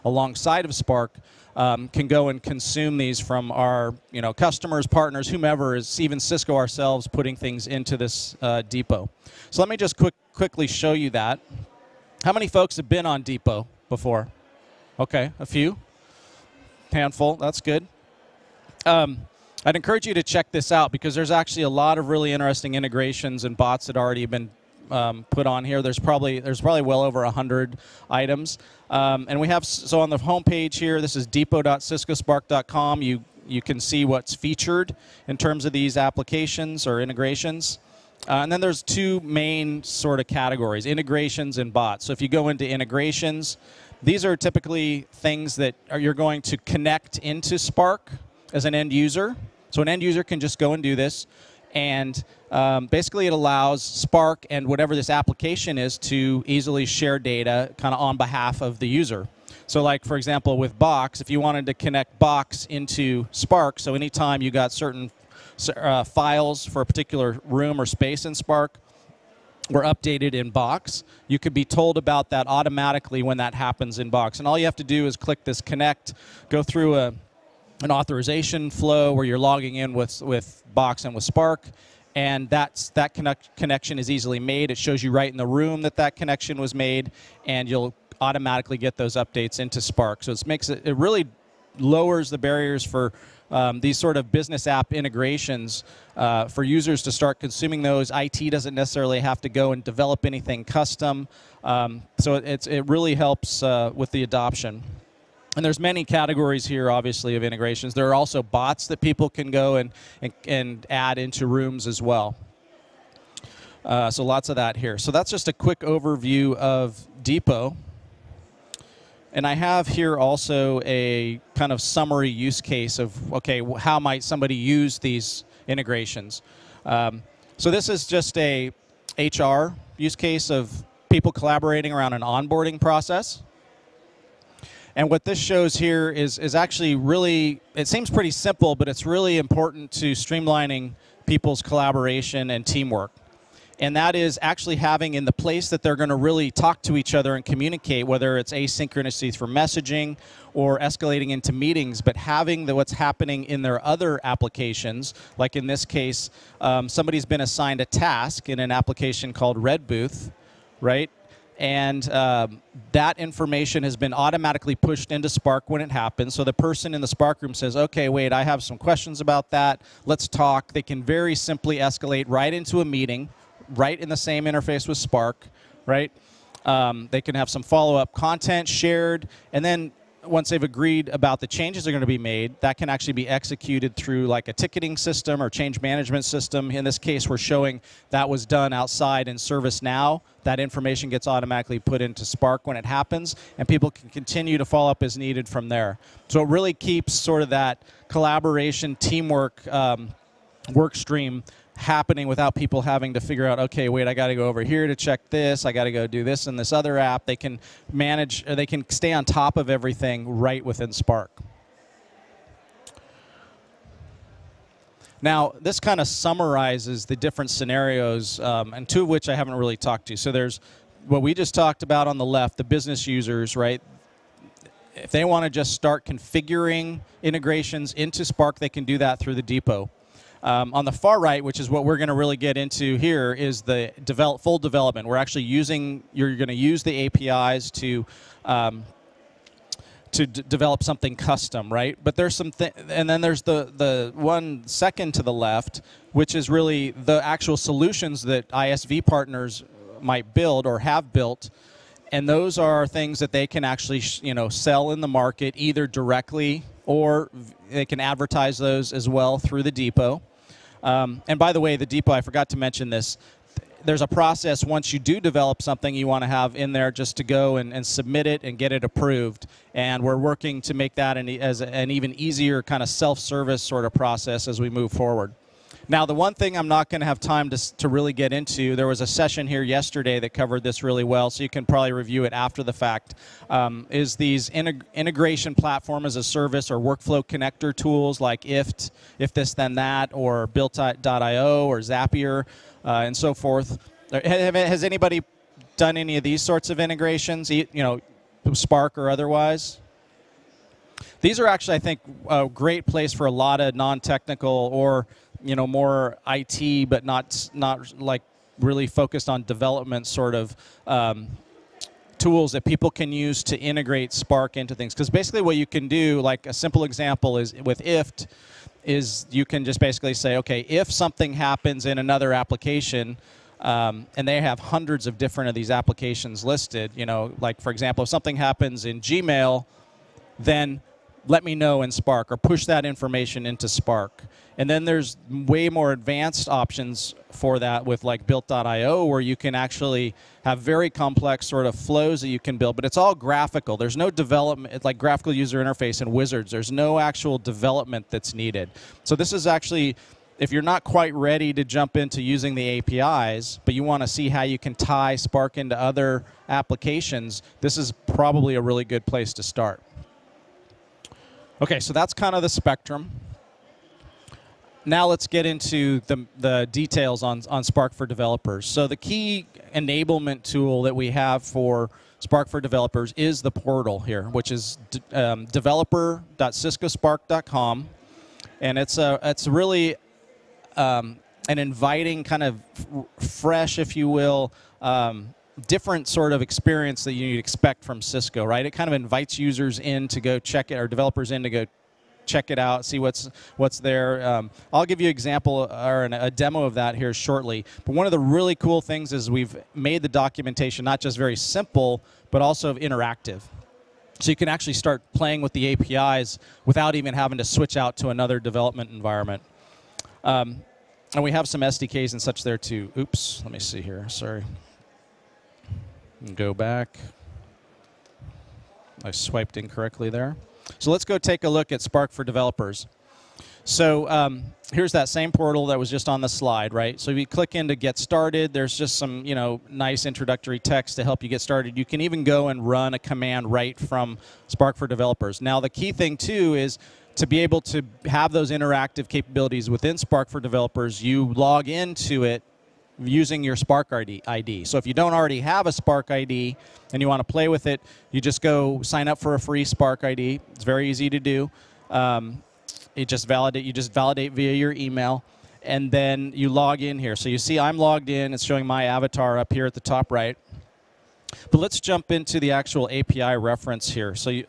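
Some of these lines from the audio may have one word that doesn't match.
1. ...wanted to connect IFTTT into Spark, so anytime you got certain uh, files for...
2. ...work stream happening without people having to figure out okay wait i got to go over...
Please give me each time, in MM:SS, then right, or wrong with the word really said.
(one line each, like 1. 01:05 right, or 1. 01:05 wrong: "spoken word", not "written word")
1. 01:01 wrong: "Box", not "IFTTT"
2. 03:20 right.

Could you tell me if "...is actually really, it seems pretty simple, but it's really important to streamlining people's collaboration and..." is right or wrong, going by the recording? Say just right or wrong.
right.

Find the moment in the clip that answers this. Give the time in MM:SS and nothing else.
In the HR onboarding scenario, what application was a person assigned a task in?
02:39.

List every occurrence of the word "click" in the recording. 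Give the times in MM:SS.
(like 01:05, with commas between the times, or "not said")
01:15, 07:07.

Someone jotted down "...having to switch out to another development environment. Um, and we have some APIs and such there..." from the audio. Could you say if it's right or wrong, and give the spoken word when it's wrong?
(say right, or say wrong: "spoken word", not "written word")
wrong: "SDKs", not "APIs".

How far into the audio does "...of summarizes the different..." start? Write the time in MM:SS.
03:36.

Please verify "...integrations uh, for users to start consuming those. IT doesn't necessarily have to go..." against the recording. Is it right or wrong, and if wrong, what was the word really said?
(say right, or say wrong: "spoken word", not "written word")
right.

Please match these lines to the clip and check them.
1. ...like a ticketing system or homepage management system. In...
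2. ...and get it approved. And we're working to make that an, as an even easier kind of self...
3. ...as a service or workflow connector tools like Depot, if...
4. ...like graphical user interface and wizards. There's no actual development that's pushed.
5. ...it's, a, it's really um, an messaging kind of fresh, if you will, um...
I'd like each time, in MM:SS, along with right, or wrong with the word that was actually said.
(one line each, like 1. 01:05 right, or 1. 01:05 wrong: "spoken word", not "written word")
1. 03:04 wrong: "change", not "homepage"
2. 04:28 right
3. 04:46 wrong: "IFTTT", not "Depot"
4. 05:44 wrong: "needed", not "pushed"
5. 06:18 wrong: "inviting", not "messaging".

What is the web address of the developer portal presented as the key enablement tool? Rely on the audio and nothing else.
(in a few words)
developer.ciscospark.com.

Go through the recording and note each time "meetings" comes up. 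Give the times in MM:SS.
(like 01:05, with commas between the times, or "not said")
02:31, 02:52.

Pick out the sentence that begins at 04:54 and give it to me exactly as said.
Uh, has anybody done any of these sorts of integrations, you know, Spark or otherwise?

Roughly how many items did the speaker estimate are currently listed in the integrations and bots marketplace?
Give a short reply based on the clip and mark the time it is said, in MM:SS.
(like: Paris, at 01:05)
over 100, at 00:26.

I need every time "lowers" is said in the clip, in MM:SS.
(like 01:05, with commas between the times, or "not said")
01:31.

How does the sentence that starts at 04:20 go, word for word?
Um, and by the way, the depot, I forgot to mention this.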